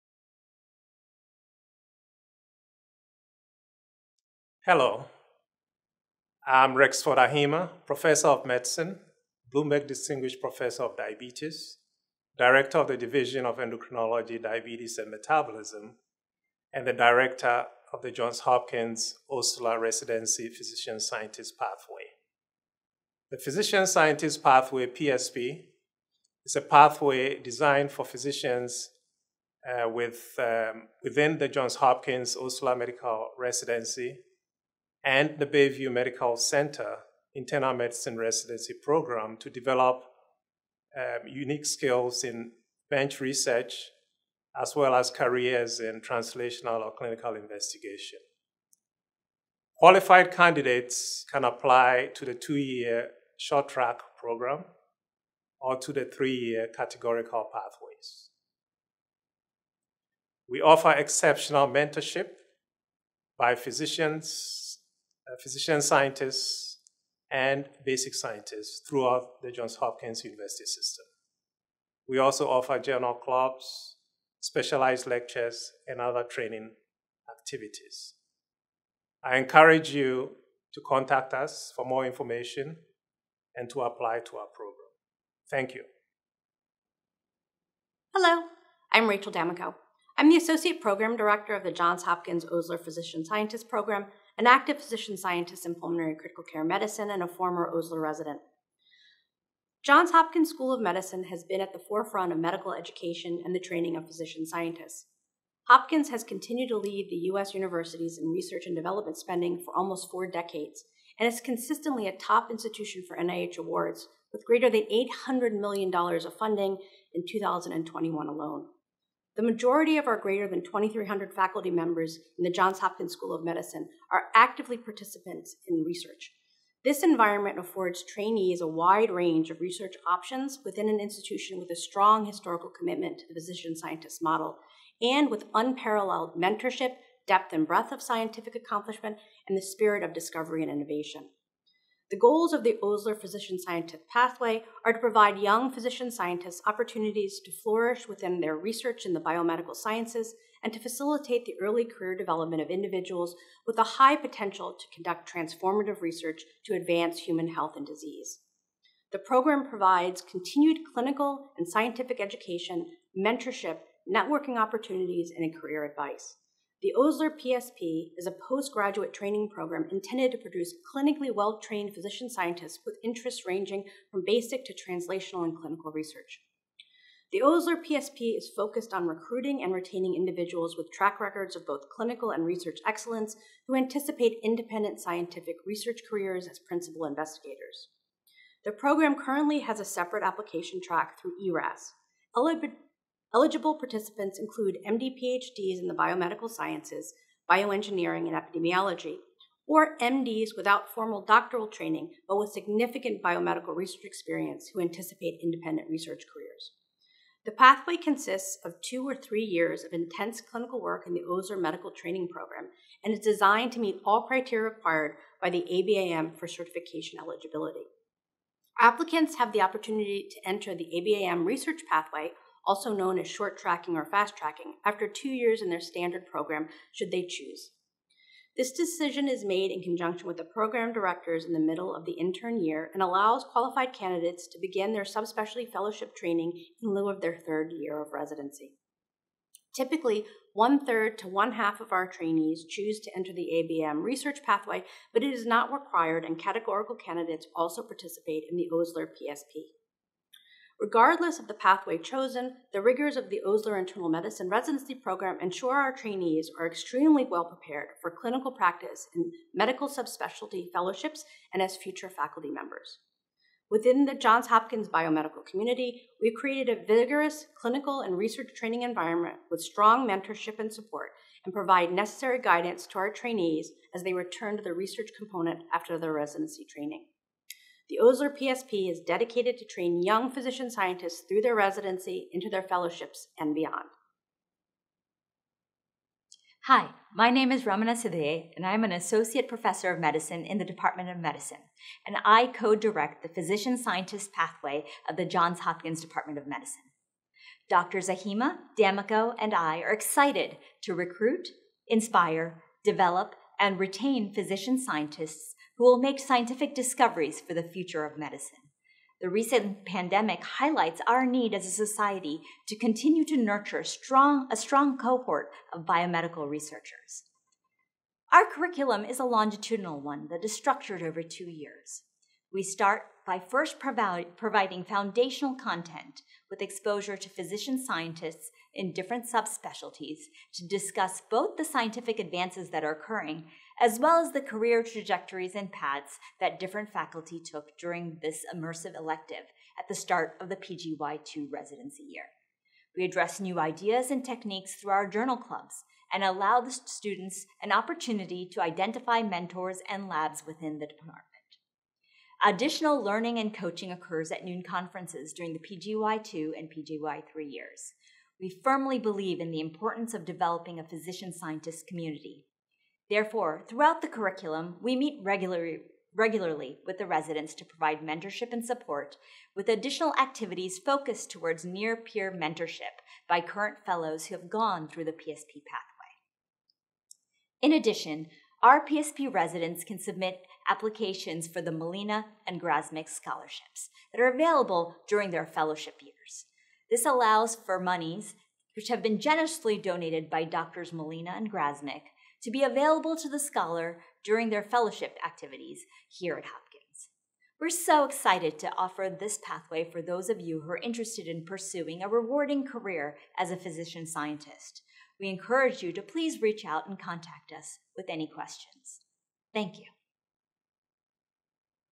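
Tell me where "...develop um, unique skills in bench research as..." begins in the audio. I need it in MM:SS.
00:39.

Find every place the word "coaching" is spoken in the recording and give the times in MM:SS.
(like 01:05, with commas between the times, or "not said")
05:53.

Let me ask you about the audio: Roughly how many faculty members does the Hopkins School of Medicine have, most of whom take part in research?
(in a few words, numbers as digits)
greater than 2,300.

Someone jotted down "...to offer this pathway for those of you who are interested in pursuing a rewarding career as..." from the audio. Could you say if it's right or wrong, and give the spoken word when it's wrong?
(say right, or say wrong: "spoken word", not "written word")
right.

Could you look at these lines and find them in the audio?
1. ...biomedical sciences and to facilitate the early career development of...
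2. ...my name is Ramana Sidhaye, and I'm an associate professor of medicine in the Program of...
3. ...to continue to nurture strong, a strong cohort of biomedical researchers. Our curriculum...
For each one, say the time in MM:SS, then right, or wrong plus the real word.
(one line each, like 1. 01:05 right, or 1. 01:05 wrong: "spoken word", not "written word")
1. 02:29 right
2. 04:47 wrong: "Department", not "Program"
3. 05:12 right.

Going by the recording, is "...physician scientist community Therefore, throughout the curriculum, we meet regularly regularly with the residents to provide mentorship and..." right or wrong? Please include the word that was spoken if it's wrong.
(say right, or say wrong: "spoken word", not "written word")
right.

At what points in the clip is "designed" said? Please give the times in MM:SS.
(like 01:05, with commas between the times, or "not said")
00:27, 03:33.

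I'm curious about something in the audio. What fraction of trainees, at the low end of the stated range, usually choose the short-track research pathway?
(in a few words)
one third.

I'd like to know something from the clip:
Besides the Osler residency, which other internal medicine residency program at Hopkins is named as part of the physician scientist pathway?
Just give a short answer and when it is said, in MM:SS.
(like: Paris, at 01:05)
Bayview Medical Center, at 00:35.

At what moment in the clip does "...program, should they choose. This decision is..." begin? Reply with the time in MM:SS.
03:46.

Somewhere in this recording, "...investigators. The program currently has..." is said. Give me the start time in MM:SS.
03:07.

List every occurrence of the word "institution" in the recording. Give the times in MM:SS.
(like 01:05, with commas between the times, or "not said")
01:52, 02:10.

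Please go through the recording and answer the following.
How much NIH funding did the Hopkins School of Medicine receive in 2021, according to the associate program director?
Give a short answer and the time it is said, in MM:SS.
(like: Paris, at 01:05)
greater than $800 million, at 01:54.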